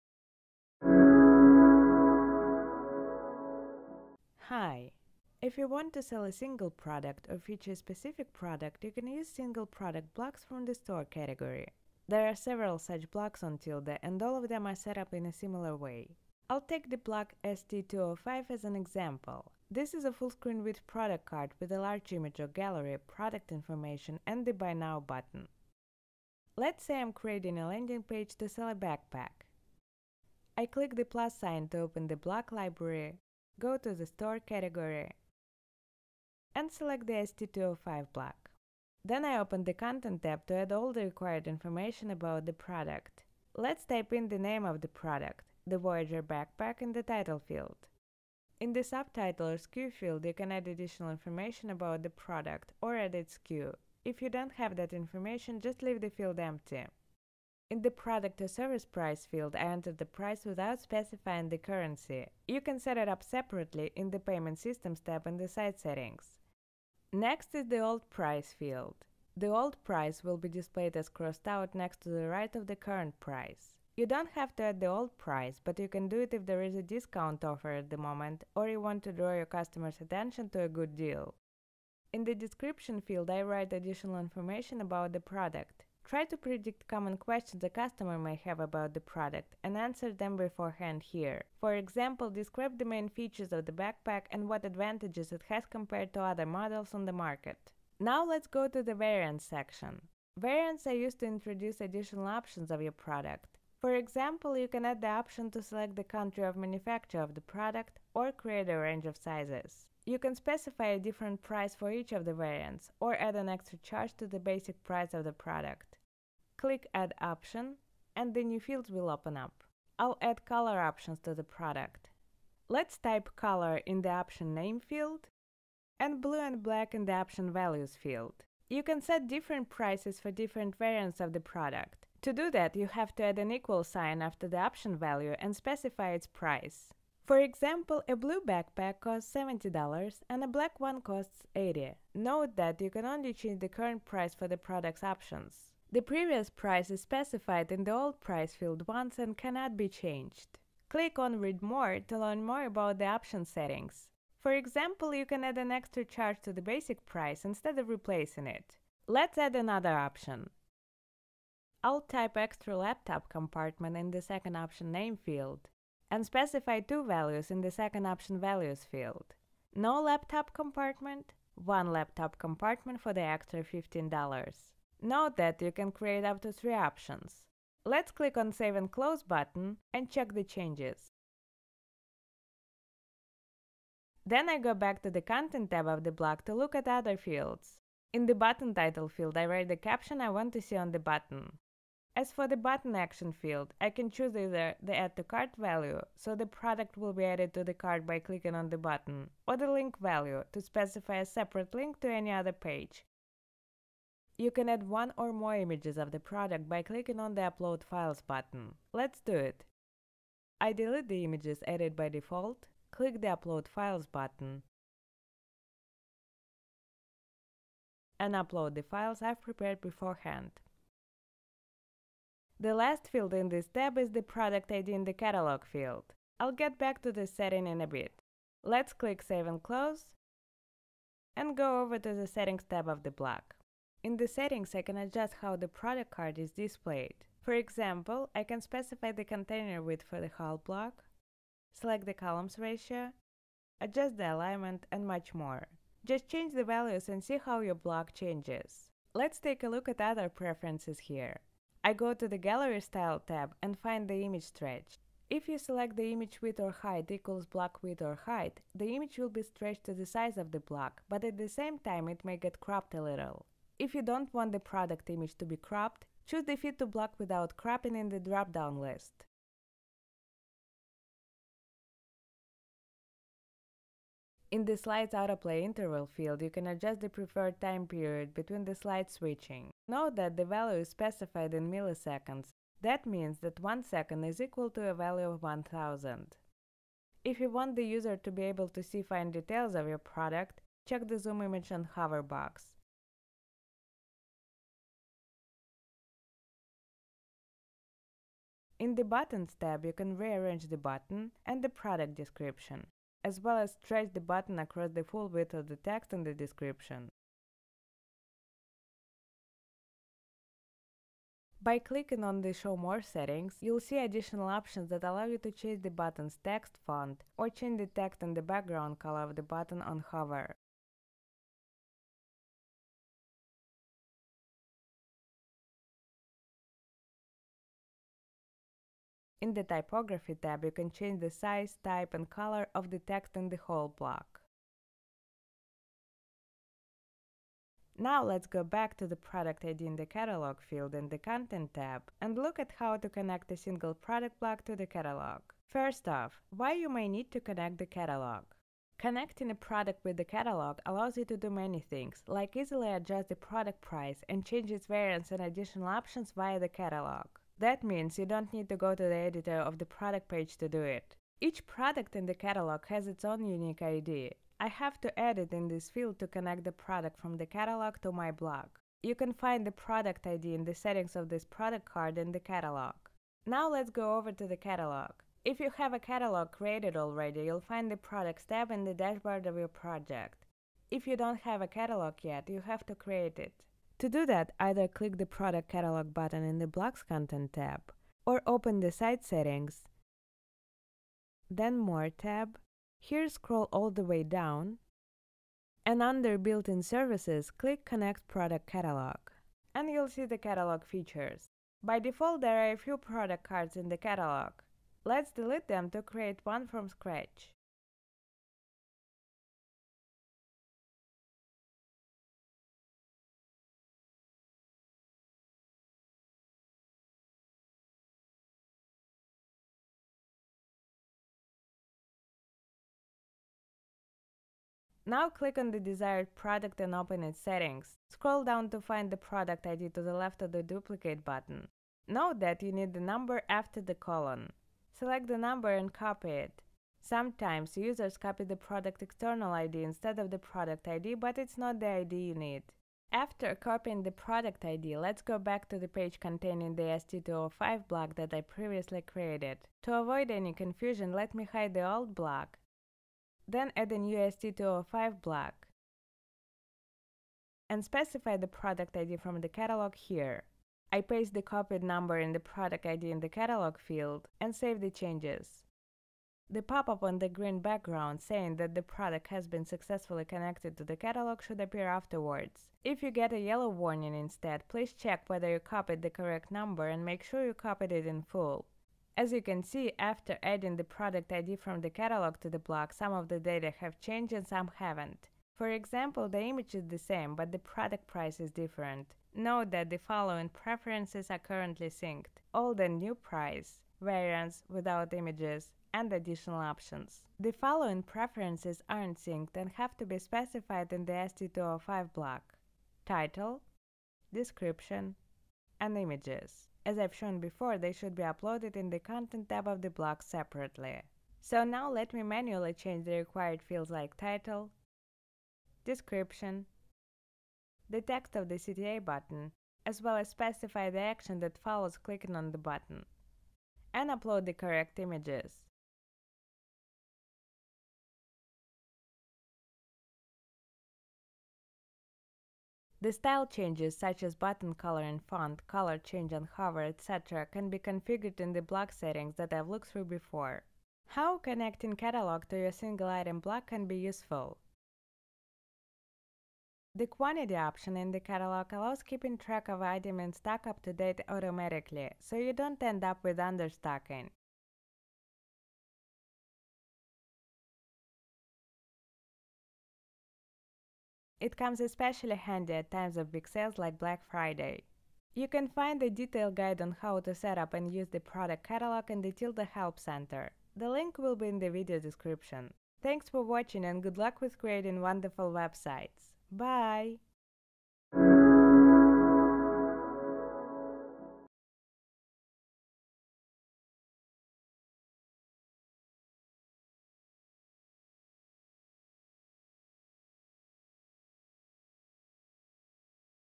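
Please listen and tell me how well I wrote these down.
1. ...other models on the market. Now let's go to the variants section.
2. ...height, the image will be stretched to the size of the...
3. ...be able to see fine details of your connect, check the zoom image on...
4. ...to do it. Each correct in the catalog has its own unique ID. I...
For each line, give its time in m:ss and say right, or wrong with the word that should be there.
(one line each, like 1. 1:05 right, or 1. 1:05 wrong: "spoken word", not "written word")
1. 1:36 right
2. 4:18 right
3. 4:48 wrong: "product", not "connect"
4. 6:00 wrong: "product", not "correct".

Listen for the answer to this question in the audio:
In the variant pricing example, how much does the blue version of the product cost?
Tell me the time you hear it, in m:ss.
2:19.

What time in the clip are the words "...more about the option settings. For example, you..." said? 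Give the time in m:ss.
2:32.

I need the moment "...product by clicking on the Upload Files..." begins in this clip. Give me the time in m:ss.
3:26.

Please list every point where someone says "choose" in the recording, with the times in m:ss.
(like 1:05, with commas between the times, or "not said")
3:14, 4:26.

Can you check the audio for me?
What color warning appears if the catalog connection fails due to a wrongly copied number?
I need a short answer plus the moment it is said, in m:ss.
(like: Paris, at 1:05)
yellow, at 7:53.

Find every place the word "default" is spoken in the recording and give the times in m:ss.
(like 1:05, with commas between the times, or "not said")
3:32, 6:41.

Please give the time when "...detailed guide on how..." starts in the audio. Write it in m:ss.
9:26.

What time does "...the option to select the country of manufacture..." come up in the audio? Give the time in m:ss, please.
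1:45.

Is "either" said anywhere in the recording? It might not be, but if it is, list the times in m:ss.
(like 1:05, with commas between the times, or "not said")
3:14, 6:24.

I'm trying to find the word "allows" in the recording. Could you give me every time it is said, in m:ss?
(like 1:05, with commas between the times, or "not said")
5:15, 5:50, 9:08.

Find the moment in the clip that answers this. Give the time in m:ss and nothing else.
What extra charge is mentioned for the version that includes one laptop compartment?
2:53.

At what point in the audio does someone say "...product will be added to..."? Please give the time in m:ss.
3:16.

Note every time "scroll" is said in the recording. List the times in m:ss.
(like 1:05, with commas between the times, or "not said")
6:33, 7:08.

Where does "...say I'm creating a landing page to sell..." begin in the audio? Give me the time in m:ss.
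0:26.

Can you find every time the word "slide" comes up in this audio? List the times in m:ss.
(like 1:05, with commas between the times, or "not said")
4:34, 4:38.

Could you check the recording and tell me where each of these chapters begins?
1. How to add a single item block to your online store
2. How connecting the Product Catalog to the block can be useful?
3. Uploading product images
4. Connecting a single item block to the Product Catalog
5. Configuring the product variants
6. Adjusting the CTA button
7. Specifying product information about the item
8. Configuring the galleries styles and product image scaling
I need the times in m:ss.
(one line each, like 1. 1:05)
1. 0:26
2. 9:01
3. 3:24
4. 5:38
5. 1:38
6. 3:08
7. 0:43
8. 4:11.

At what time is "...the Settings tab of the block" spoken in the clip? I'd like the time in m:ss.
3:52.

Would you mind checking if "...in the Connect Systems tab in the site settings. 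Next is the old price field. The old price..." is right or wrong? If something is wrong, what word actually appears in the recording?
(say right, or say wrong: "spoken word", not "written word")
wrong: "Payment", not "Connect".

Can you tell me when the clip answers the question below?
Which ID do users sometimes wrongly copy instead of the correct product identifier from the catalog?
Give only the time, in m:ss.
7:19.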